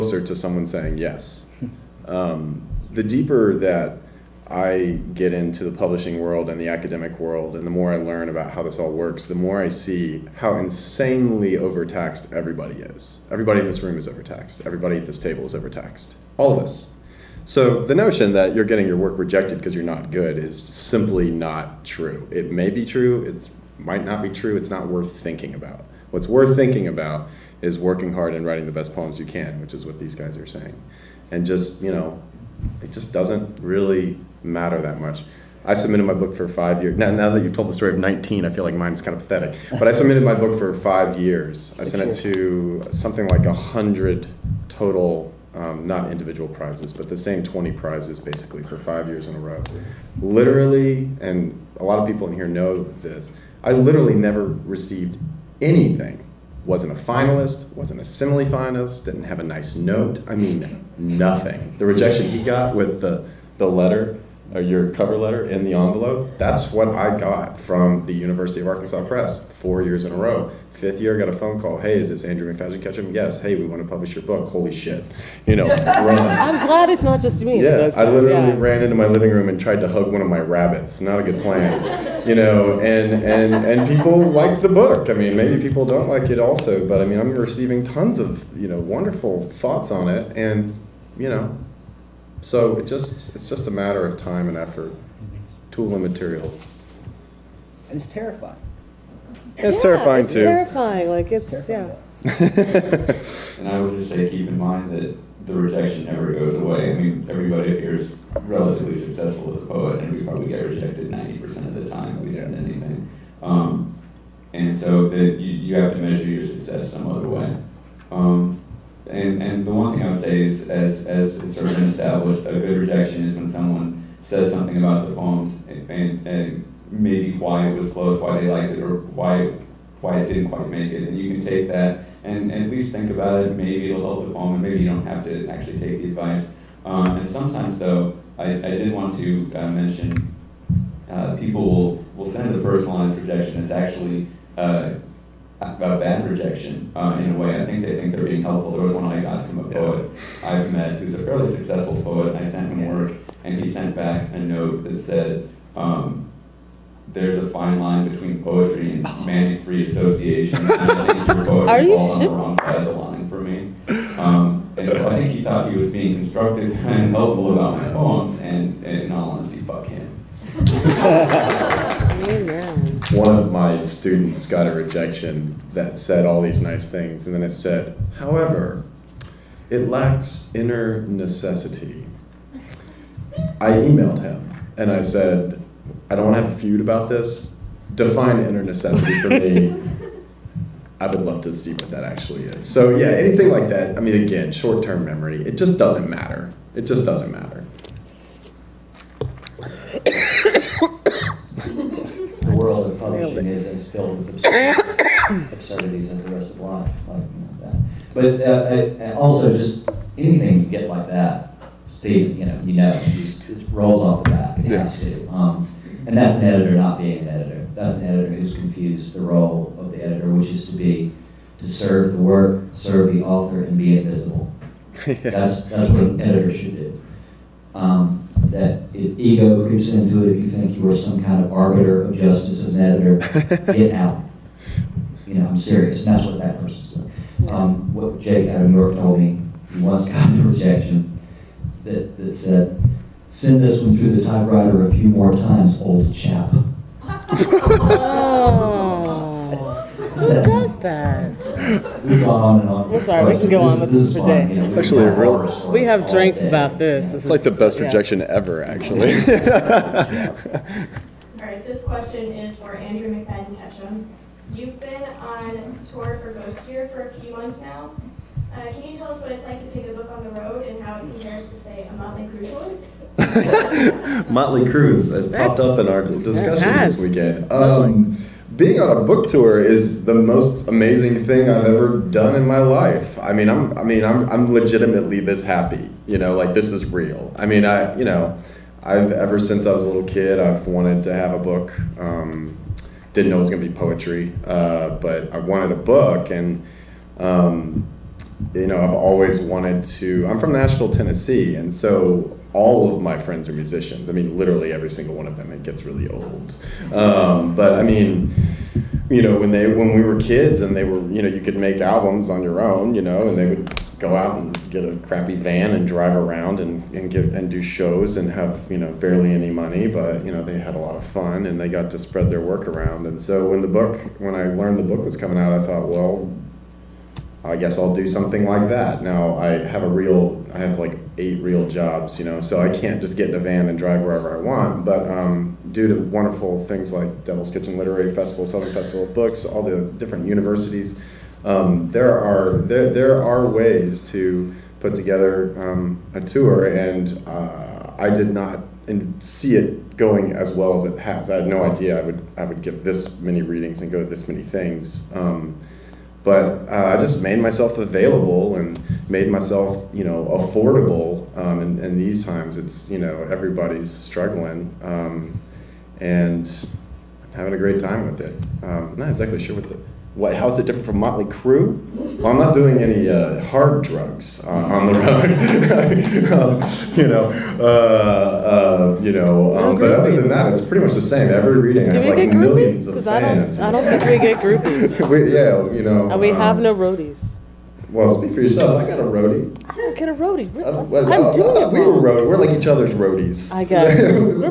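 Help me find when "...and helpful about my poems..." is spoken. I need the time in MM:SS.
02:46.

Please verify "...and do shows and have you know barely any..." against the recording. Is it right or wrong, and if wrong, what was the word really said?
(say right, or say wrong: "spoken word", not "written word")
right.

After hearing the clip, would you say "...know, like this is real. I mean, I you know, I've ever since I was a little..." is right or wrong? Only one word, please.
right.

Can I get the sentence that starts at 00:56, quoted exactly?
Wasn't a finalist, wasn't a simile finalist, didn't have a nice note.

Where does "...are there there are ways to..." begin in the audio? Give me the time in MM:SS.
05:42.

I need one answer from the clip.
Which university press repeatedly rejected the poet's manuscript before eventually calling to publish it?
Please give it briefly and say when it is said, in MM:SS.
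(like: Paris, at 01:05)
University of Arkansas Press, at 01:08.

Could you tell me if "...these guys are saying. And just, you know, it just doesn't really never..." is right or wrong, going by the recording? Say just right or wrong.
wrong.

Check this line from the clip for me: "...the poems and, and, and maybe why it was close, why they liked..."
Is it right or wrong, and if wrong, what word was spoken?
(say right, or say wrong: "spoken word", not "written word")
right.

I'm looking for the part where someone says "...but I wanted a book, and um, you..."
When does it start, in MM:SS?
04:54.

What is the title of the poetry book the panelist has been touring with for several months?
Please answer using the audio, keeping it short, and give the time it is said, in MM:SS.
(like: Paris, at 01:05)
Ghost Gear, at 04:26.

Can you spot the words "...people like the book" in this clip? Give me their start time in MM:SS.
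01:23.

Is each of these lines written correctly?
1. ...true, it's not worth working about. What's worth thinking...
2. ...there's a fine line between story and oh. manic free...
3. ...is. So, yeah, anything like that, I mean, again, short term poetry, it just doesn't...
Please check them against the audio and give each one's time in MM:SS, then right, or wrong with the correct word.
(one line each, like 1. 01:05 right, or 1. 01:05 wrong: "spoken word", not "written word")
1. 00:24 wrong: "thinking", not "working"
2. 02:37 wrong: "poetry", not "story"
3. 03:12 wrong: "memory", not "poetry".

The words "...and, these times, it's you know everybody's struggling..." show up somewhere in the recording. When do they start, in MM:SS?
06:01.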